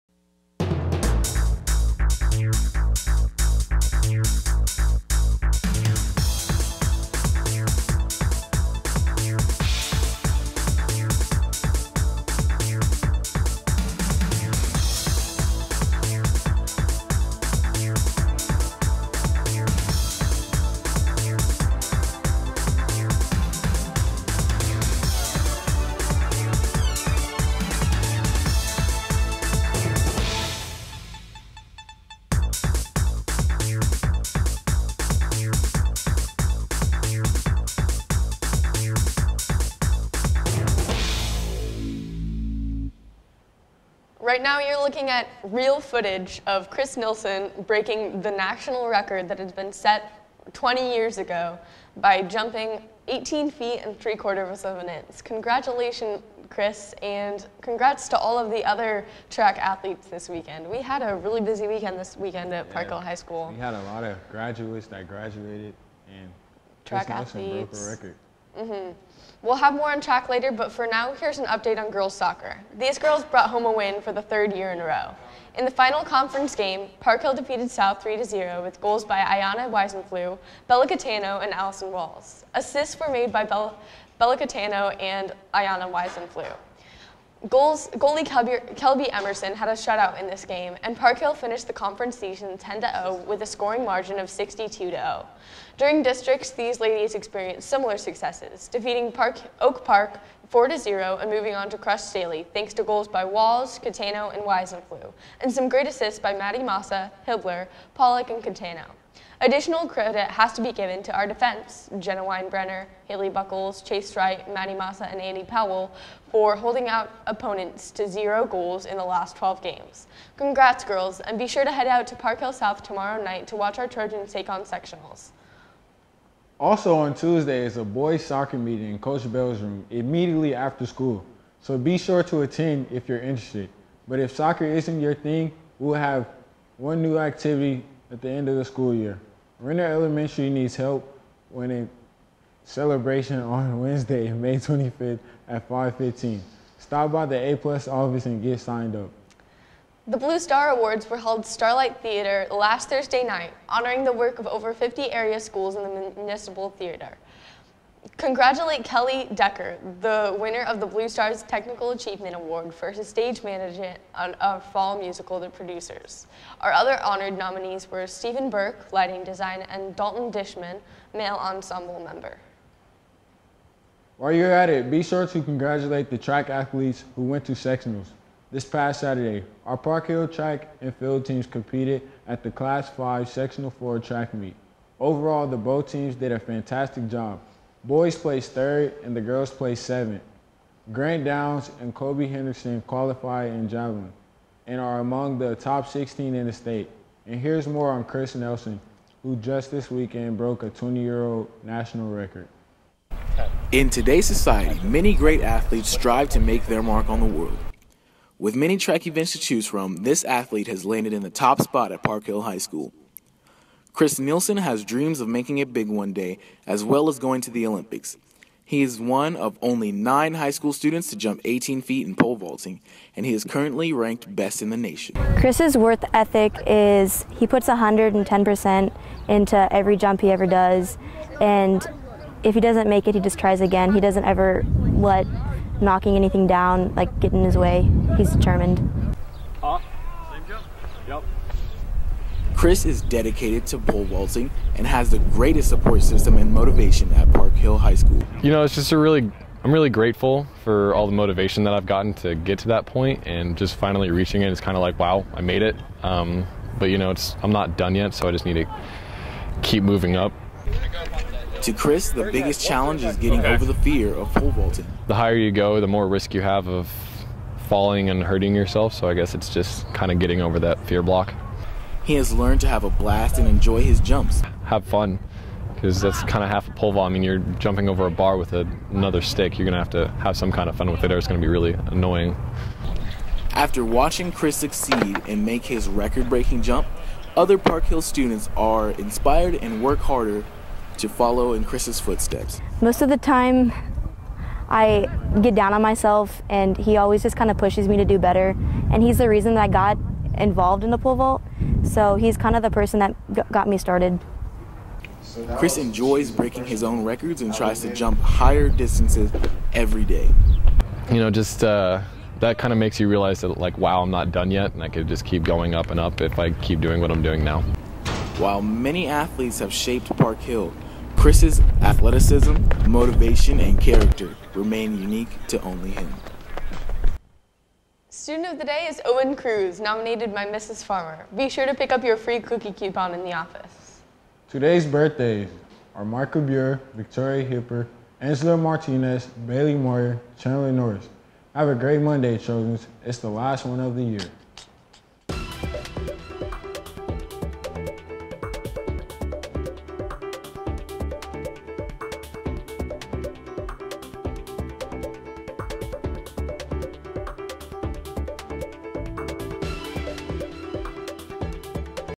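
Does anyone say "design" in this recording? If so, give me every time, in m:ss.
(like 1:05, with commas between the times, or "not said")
2:49.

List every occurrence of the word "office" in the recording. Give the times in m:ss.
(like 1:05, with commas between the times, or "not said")
2:27, 5:33.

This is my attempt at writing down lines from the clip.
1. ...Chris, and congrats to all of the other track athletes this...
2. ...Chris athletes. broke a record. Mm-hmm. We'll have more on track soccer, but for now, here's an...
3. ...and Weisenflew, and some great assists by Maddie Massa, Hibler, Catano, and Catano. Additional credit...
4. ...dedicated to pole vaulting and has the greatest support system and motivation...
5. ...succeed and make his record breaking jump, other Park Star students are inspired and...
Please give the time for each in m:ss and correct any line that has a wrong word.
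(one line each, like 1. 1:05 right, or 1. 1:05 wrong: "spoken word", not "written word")
1. 0:56 right
2. 1:07 wrong: "later", not "soccer"
3. 1:44 wrong: "Pollock", not "Catano"
4. 4:03 right
5. 4:44 wrong: "Hill", not "Star".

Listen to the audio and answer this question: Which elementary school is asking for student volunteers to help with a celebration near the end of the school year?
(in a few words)
Renner Elementary.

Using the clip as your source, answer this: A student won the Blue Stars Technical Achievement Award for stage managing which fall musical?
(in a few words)
The Producers.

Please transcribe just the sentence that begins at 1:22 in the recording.
Assists were made by Bella, Bella Catano and Ayana Weisenflew.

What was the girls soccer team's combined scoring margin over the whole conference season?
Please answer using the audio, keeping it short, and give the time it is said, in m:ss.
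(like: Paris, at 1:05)
62-0, at 1:34.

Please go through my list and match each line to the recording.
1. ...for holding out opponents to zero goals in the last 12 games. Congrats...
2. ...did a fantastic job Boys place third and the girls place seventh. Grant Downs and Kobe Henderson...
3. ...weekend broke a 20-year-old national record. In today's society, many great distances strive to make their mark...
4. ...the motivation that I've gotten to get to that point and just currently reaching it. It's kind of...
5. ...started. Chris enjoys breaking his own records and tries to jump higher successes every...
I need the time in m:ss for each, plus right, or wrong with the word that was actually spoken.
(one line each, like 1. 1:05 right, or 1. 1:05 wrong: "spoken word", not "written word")
1. 1:56 right
2. 3:06 right
3. 3:19 wrong: "athletes", not "distances"
4. 4:11 wrong: "finally", not "currently"
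5. 5:03 wrong: "distances", not "successes".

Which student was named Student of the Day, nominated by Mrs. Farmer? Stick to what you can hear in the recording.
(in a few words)
Owen Cruz.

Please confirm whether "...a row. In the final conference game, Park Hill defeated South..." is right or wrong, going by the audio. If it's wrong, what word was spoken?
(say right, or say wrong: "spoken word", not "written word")
right.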